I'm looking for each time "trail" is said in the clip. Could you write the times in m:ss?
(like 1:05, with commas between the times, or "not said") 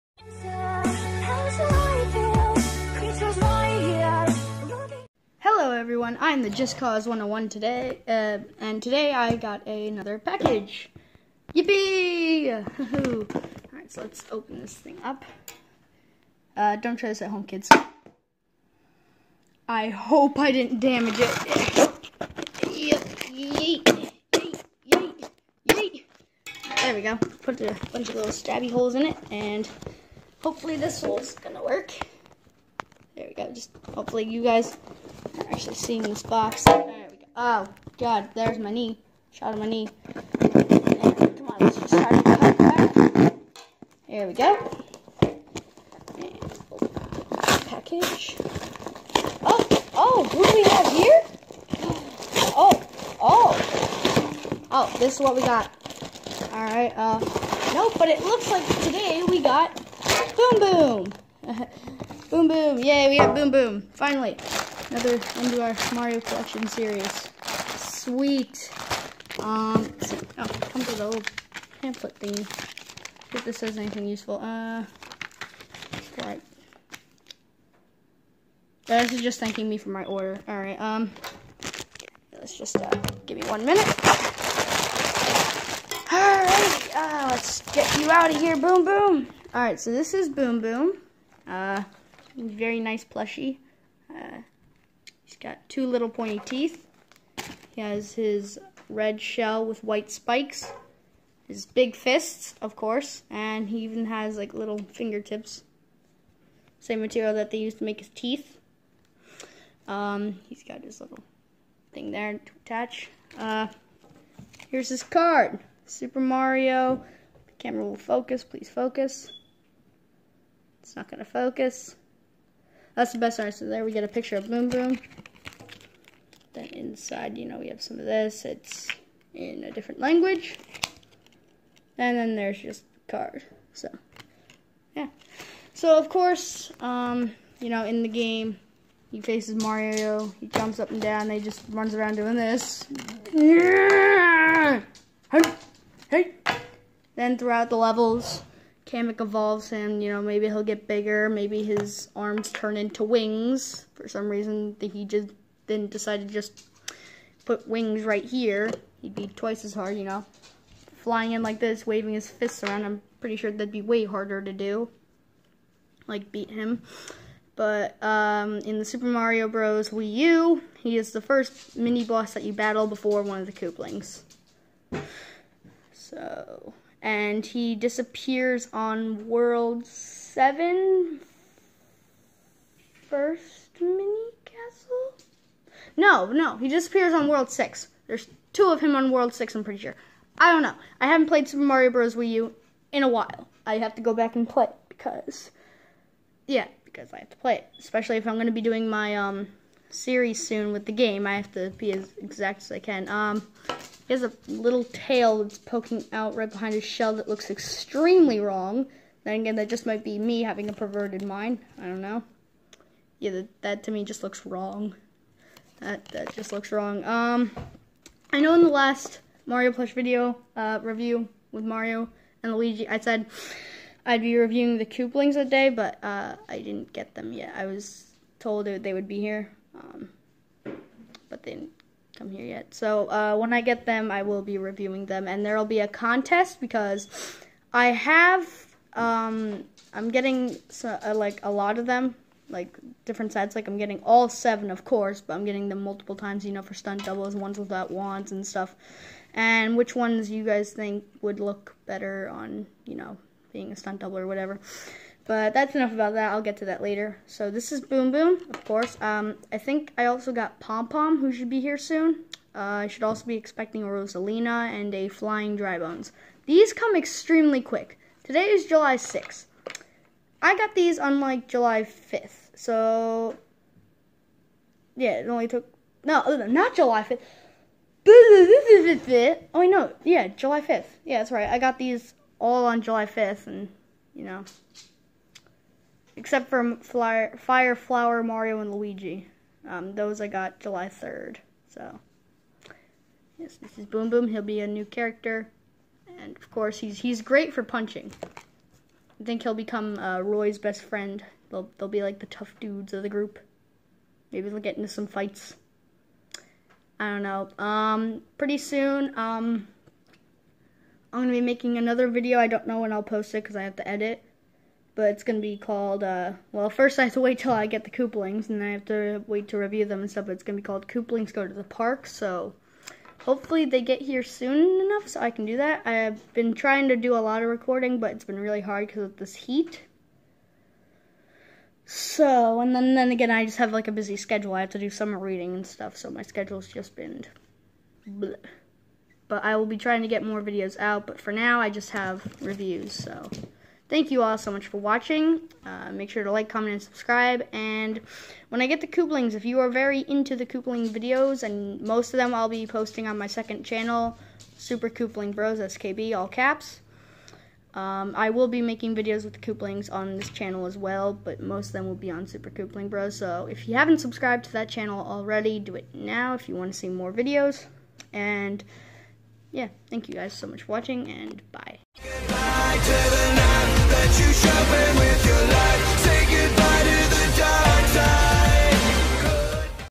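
not said.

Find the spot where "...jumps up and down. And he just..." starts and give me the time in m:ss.
2:20.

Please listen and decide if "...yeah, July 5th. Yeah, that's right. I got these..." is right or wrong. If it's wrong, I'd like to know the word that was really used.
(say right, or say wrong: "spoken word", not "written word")
right.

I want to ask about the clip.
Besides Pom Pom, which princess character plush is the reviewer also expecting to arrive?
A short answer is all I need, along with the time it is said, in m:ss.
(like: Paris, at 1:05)
Rosalina, at 4:23.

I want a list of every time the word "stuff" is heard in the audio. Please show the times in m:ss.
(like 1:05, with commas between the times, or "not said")
4:08, 5:20, 5:35.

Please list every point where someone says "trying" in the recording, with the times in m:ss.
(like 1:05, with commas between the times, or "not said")
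5:26, 5:39.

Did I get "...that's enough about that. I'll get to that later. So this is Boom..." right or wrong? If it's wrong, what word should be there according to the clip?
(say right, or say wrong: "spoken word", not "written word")
right.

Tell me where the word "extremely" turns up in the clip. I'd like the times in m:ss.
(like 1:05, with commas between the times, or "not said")
3:27, 4:26.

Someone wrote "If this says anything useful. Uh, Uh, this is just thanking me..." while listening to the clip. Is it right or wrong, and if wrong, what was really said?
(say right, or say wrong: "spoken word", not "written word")
right.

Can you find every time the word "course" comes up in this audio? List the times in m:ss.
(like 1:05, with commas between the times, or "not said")
1:42, 2:16, 4:04, 4:18, 4:56.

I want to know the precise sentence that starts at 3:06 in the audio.
No, no, he disappears on World 6.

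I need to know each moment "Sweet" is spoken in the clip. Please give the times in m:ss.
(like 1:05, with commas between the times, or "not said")
1:07.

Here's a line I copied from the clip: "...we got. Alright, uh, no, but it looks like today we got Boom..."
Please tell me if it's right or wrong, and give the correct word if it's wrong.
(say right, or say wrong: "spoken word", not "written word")
right.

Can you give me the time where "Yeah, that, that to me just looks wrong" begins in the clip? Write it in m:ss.
3:33.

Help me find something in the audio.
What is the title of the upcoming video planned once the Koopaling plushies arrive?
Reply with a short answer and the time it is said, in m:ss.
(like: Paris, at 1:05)
Koopalings Go to the Park, at 5:20.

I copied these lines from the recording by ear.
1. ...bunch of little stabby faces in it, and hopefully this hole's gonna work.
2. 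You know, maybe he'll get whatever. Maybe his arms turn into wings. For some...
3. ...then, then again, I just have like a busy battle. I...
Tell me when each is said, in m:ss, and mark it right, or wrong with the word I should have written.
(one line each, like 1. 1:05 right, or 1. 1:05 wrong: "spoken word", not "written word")
1. 0:27 wrong: "holes", not "faces"
2. 2:30 wrong: "bigger", not "whatever"
3. 5:32 wrong: "schedule", not "battle".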